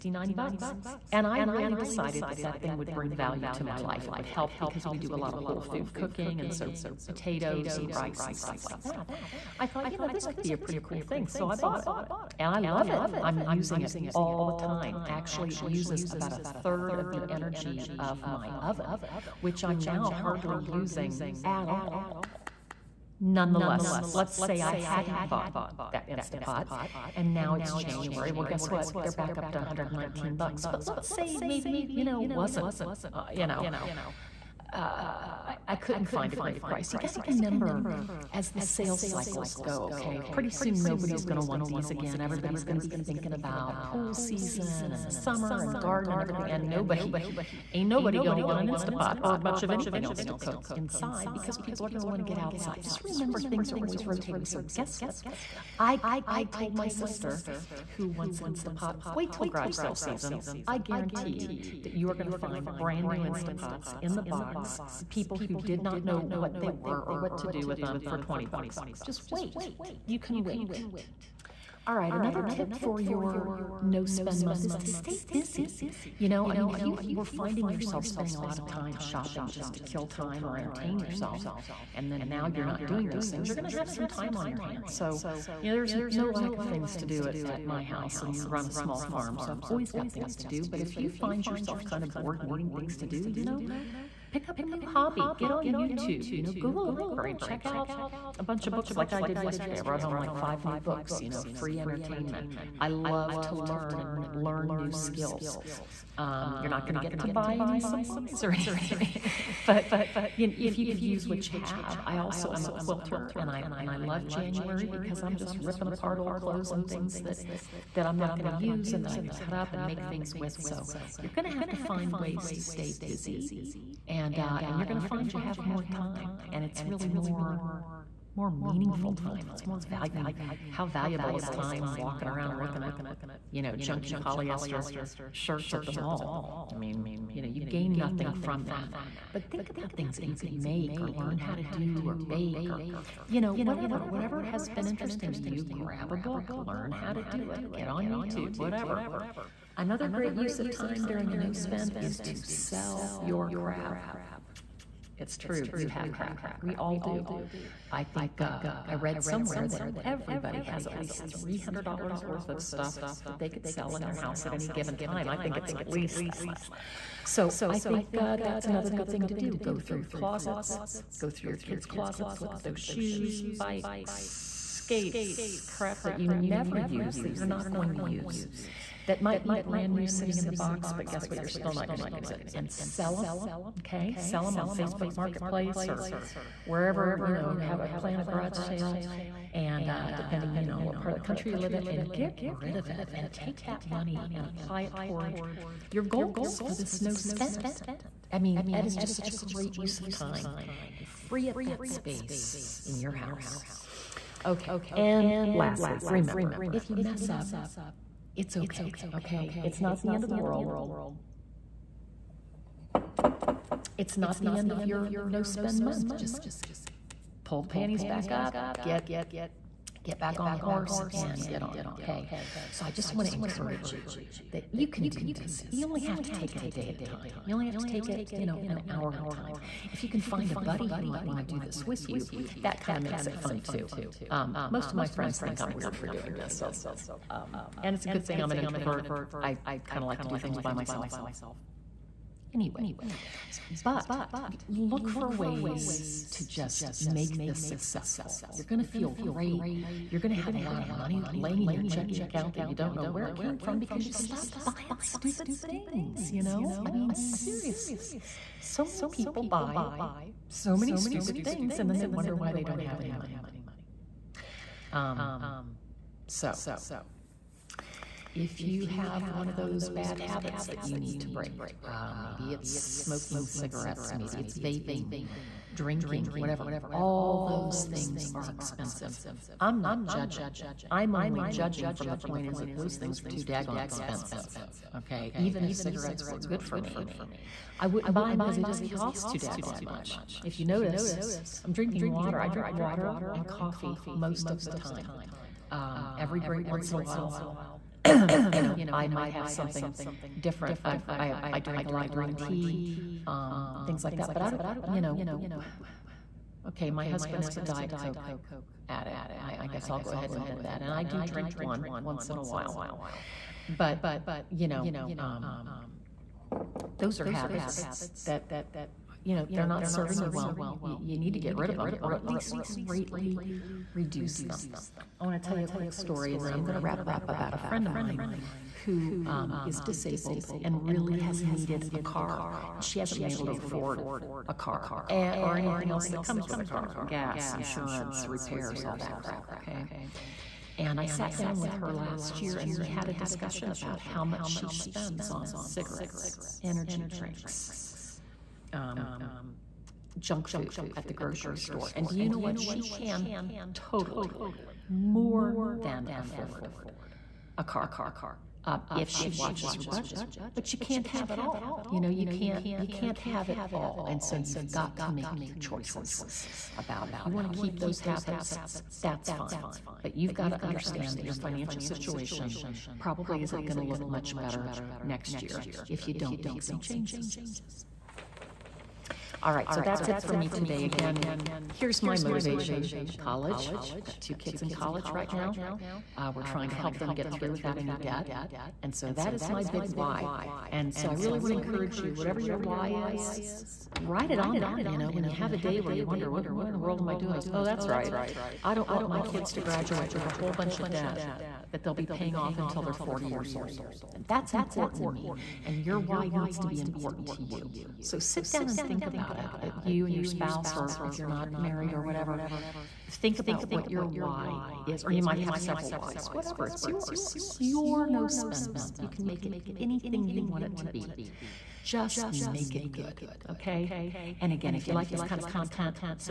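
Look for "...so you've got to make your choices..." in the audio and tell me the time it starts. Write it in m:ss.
6:04.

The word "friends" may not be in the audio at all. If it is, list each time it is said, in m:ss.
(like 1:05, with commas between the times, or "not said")
3:55, 5:27.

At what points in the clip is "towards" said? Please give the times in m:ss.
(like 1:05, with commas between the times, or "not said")
3:14.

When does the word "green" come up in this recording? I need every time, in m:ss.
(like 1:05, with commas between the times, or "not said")
5:02.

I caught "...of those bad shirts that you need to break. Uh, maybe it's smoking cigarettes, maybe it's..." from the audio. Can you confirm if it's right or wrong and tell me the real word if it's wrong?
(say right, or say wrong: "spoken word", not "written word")
wrong: "habits", not "shirts".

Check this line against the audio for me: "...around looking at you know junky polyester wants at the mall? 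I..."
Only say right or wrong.
wrong.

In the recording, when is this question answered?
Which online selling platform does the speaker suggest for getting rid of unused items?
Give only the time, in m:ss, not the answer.
3:04.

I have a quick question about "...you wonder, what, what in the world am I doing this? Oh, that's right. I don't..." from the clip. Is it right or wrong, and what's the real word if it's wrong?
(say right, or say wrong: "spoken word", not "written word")
right.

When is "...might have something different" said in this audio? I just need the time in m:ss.
4:59.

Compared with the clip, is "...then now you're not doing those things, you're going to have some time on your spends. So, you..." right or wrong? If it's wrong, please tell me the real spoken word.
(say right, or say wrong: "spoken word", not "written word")
wrong: "hands", not "spends".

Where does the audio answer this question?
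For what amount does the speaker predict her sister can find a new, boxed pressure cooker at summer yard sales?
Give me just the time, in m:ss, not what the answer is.
1:08.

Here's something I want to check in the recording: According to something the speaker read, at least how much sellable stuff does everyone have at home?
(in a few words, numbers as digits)
$300.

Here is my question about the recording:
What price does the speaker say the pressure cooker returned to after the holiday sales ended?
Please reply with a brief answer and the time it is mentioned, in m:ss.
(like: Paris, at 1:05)
$119, at 0:29.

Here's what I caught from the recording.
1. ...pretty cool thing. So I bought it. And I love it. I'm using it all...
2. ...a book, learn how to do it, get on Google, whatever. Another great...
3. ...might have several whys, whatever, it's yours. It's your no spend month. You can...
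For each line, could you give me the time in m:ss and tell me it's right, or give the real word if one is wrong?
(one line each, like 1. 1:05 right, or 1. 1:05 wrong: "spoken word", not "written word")
1. 0:10 right
2. 2:26 wrong: "YouTube", not "Google"
3. 6:55 right.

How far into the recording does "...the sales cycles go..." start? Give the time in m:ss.
0:38.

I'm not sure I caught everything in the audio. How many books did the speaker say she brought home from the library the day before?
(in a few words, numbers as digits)
5.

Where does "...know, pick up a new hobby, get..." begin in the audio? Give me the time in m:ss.
1:33.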